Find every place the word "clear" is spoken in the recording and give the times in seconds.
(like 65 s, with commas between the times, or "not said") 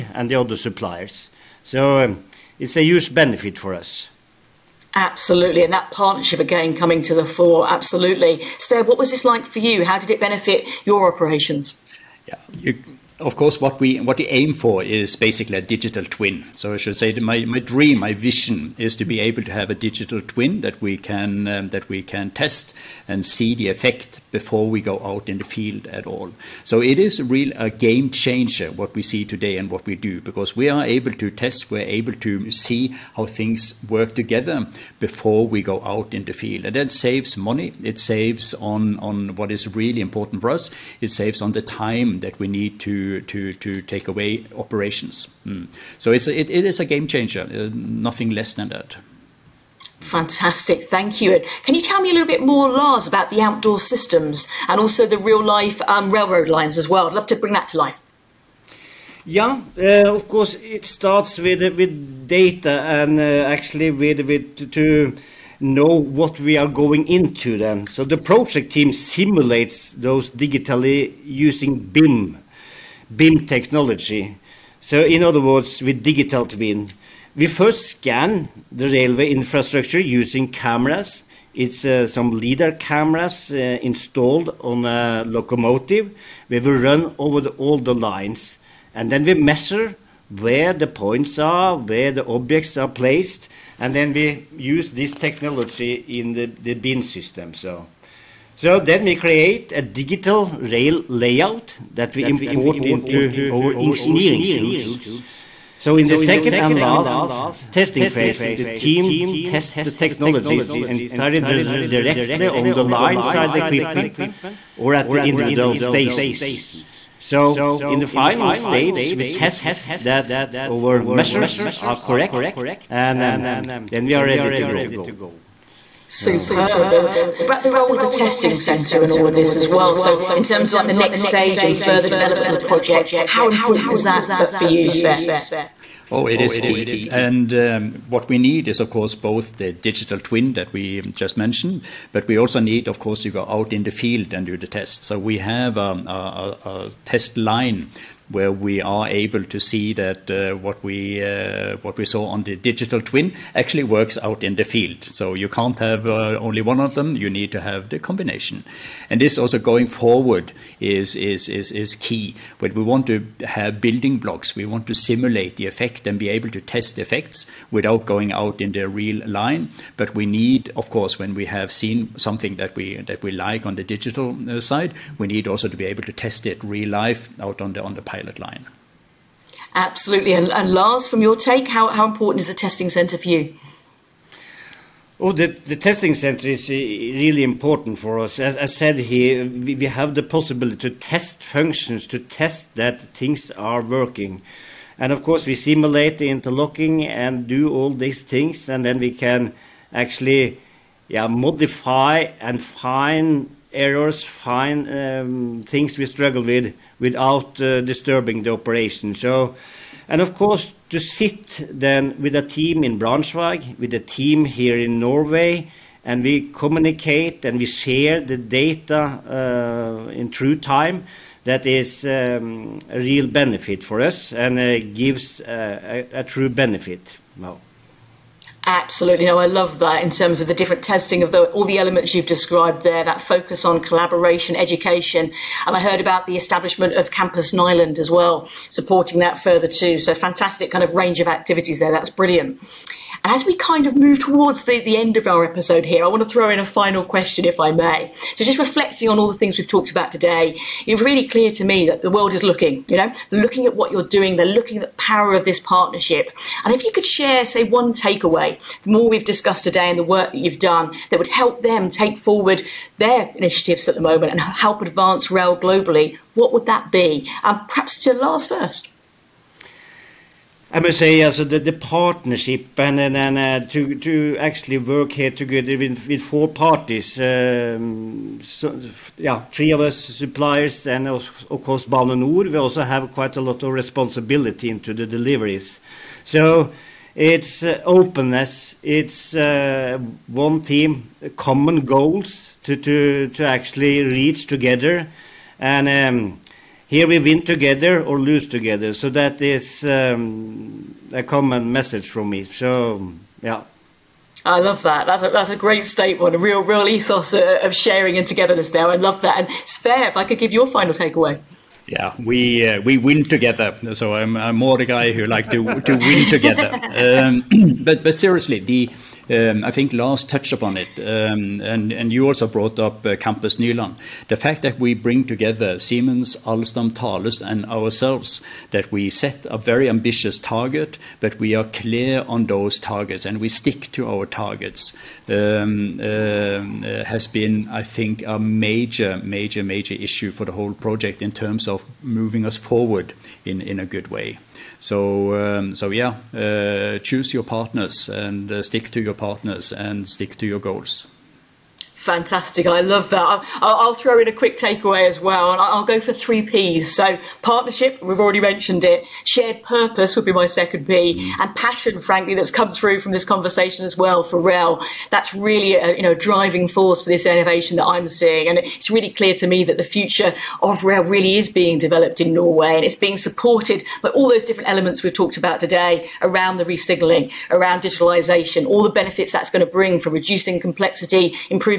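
251 s, 331 s, 369 s.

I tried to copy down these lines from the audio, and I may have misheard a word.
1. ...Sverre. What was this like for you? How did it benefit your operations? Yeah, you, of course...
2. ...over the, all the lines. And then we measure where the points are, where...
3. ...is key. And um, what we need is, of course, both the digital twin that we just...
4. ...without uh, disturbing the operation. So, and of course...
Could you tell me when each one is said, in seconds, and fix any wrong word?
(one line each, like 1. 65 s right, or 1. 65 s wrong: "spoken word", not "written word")
1. 8 s right
2. 87 s right
3. 136 s right
4. 206 s right.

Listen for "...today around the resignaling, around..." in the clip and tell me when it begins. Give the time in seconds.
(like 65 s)
375 s.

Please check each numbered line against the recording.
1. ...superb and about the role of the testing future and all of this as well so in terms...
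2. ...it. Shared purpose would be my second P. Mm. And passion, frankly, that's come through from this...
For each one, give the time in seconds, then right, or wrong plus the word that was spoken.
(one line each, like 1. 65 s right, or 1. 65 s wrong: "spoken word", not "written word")
1. 126 s wrong: "centre", not "future"
2. 358 s right.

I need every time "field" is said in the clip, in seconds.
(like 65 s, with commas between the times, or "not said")
25 s, 36 s, 143 s, 154 s.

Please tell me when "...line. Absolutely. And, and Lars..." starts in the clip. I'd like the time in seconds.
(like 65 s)
178 s.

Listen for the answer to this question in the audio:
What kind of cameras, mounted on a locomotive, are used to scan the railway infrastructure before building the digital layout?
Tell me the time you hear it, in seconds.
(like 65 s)
82 s.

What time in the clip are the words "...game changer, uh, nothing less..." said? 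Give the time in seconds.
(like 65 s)
46 s.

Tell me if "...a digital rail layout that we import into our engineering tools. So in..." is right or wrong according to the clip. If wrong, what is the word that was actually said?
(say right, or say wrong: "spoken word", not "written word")
right.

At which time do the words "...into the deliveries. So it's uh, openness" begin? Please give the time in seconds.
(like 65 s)
284 s.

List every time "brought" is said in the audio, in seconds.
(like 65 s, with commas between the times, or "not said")
322 s.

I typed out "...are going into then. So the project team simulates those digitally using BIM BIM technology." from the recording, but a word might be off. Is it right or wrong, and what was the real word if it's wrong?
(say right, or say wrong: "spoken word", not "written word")
right.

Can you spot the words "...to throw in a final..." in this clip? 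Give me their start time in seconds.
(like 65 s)
246 s.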